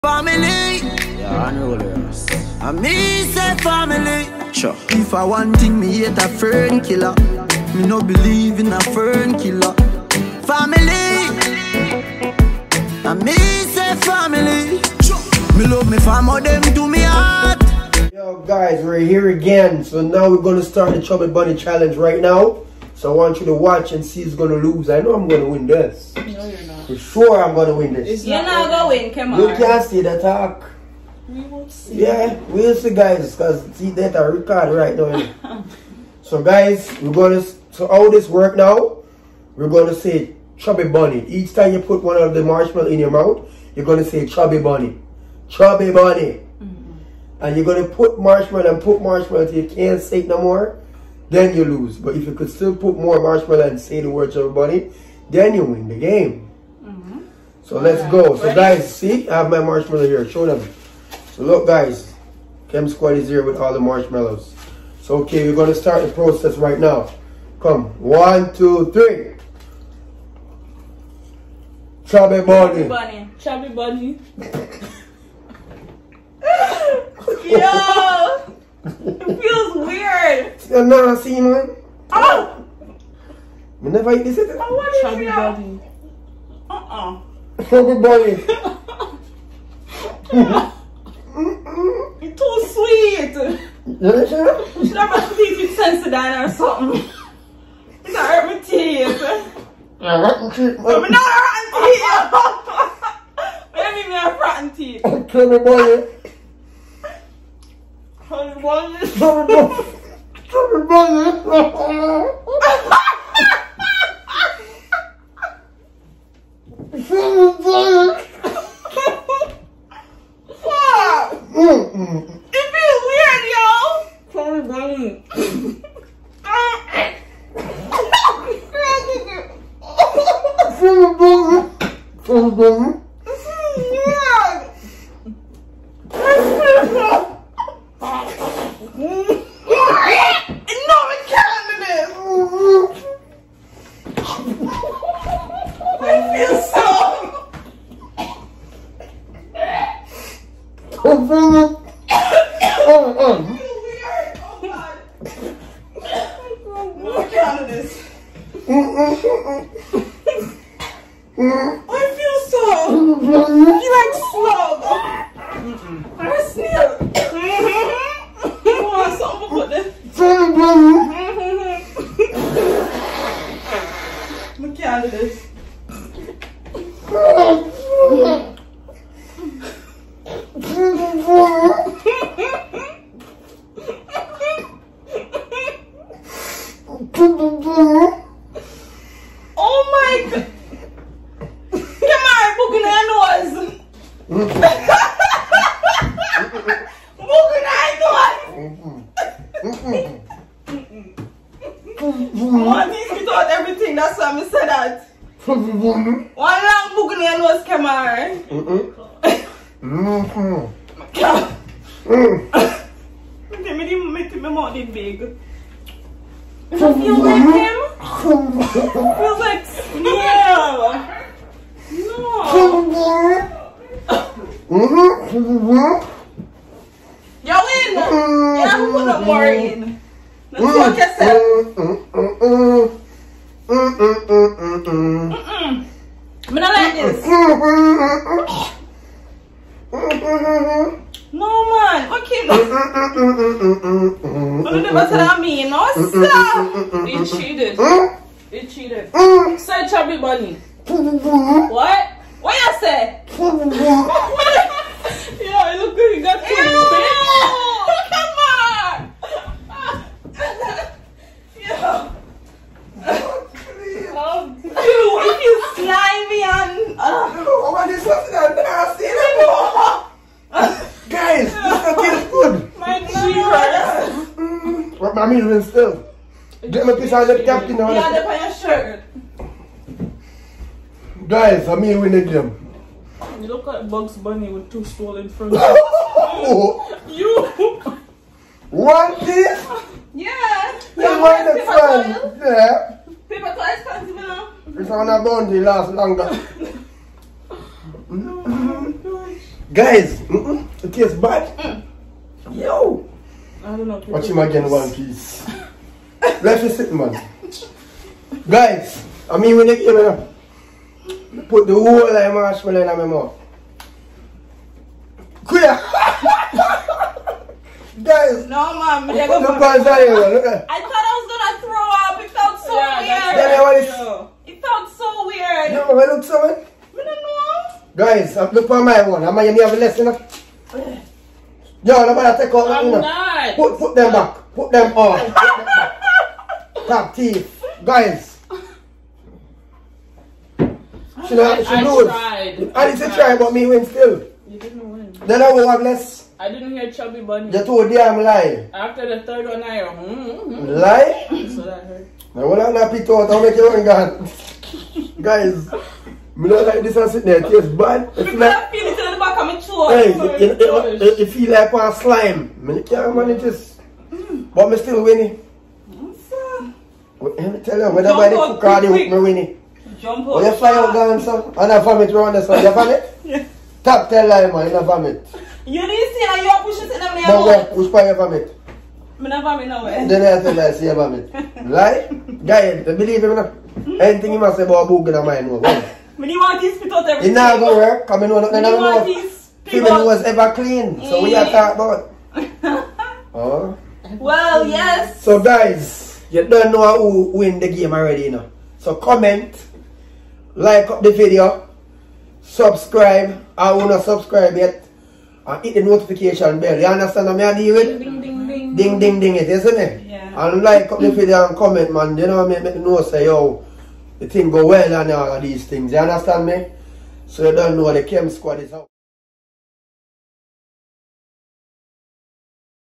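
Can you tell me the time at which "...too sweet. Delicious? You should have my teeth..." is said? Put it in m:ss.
1:32.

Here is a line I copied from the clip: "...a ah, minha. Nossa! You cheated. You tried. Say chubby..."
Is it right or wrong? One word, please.
wrong.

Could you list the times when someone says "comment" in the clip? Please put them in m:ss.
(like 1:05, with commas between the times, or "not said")
6:38, 6:51.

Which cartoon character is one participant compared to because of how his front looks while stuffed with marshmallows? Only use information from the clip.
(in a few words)
Bugs Bunny.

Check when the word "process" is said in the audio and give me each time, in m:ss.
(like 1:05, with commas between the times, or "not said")
1:06.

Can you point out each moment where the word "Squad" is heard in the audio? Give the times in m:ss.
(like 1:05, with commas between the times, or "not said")
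1:02, 6:58.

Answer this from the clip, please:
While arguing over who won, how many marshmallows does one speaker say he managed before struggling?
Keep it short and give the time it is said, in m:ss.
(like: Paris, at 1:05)
3, at 5:49.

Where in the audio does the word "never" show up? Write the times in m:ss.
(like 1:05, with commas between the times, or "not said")
1:23.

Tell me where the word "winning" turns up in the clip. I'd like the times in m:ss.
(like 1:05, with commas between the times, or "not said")
6:05, 6:09.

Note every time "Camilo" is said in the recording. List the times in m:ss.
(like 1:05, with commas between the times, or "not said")
4:35.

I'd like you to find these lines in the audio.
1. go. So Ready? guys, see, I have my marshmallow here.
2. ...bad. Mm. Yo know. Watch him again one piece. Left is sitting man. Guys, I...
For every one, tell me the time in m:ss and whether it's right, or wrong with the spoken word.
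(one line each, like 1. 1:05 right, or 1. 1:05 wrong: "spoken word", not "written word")
1. 0:58 right
2. 5:01 right.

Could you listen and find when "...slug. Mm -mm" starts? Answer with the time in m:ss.
2:44.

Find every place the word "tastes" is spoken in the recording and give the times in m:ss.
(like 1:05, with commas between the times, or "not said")
5:00, 5:57.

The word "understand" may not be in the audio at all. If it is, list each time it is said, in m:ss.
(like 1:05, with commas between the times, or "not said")
6:46, 6:55.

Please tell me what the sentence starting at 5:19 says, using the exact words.
Look at I thought I was gonna throw up.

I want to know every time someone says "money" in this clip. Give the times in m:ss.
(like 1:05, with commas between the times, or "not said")
3:34.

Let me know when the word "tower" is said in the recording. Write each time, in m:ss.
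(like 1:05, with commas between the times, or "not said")
not said.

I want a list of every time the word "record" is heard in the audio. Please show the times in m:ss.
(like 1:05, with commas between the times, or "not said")
0:34.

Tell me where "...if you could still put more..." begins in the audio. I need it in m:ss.
0:52.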